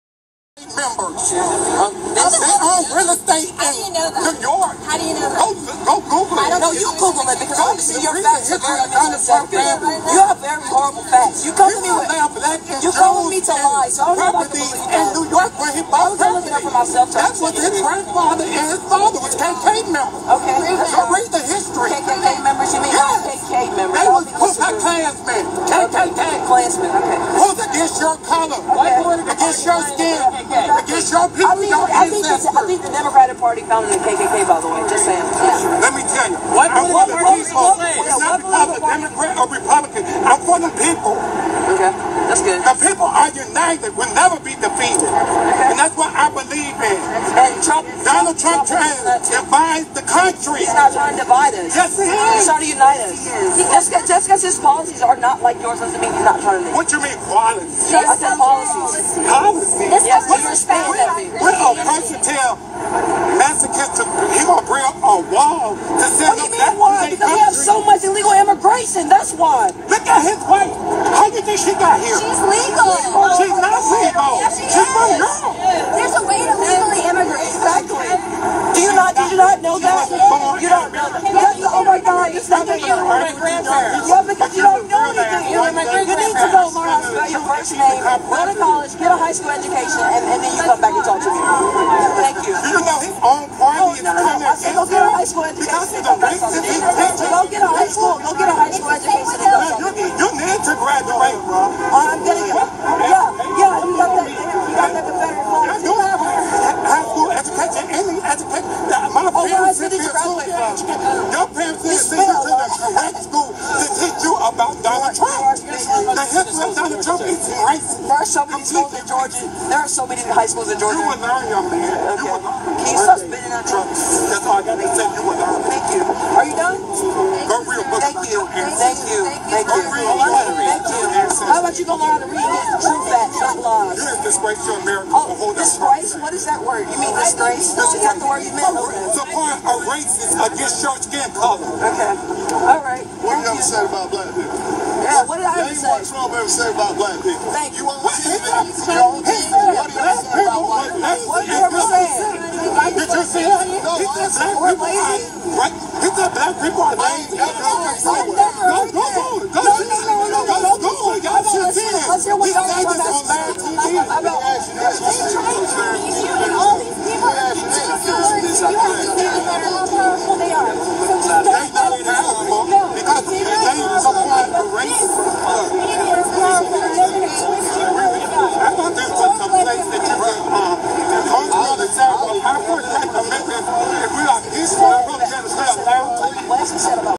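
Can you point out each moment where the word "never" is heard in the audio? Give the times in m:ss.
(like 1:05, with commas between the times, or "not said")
0:44.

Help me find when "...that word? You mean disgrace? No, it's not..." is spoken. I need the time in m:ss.
2:16.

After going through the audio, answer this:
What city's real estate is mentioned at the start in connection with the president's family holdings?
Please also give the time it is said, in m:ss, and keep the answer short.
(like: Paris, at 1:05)
Manhattan, at 0:02.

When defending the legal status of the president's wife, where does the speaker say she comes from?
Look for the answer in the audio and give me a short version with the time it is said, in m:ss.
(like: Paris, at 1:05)
Europe, at 1:15.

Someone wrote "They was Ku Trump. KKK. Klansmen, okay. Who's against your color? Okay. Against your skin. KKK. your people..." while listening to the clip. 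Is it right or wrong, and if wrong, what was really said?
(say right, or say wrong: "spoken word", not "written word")
wrong: "Klansmen", not "Trump".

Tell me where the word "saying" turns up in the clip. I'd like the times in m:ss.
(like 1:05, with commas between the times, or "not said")
0:35, 1:00.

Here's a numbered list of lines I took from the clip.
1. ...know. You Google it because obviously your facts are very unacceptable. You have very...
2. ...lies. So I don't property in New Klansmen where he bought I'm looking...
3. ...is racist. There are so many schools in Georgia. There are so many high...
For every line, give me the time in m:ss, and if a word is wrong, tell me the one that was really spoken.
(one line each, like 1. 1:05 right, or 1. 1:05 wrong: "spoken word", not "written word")
1. 0:06 right
2. 0:13 wrong: "York", not "Klansmen"
3. 1:57 right.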